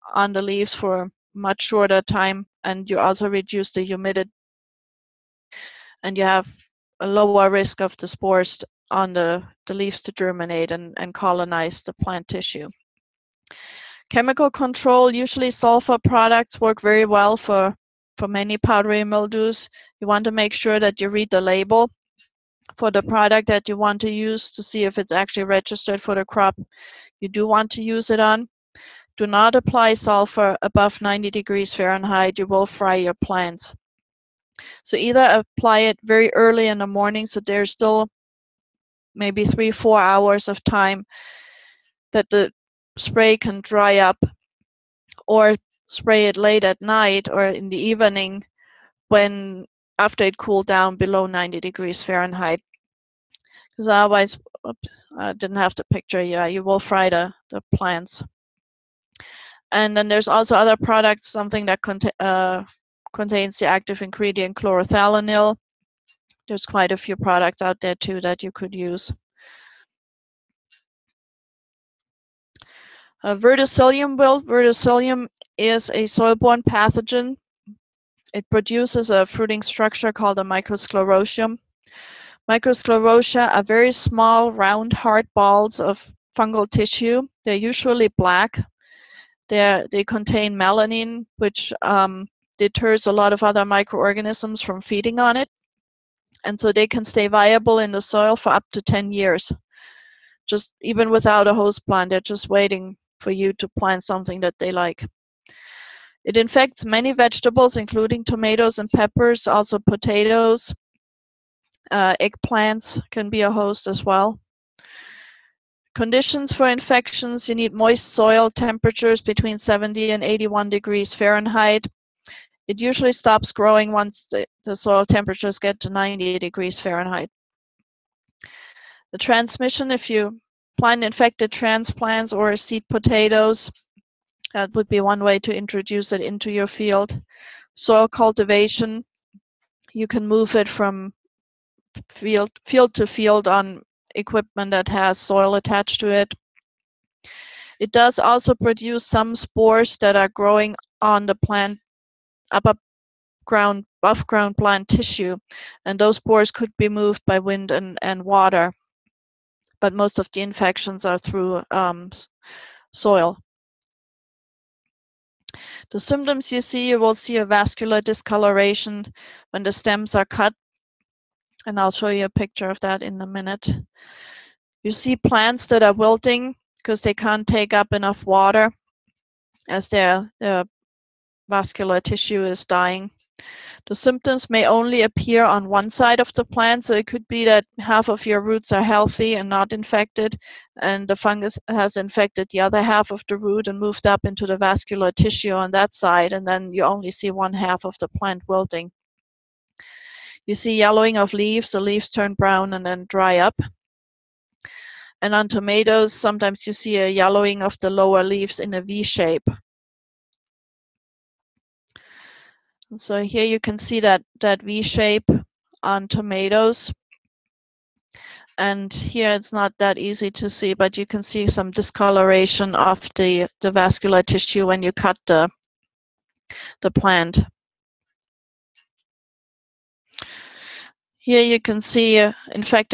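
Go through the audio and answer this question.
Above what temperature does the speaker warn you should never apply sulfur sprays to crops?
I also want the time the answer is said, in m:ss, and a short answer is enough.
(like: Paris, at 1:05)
90 degrees Fahrenheit, at 0:30.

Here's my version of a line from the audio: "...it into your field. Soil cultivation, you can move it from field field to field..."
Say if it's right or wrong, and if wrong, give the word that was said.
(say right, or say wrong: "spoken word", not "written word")
right.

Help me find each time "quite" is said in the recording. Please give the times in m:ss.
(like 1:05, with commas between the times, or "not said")
1:06.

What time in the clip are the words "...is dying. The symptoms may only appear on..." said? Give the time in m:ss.
3:02.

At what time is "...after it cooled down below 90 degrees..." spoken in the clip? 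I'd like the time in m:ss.
0:49.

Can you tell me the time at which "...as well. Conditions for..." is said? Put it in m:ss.
1:53.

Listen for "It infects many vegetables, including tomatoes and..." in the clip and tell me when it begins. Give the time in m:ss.
1:46.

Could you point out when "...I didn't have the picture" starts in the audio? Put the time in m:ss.
0:55.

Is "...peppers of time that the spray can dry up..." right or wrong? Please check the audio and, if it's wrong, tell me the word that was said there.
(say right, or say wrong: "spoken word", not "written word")
wrong: "hours", not "peppers".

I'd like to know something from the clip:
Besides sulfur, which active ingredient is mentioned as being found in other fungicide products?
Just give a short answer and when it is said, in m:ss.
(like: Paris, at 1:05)
chlorothalonil, at 1:04.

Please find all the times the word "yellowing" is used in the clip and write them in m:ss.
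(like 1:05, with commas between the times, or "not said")
3:20, 3:27.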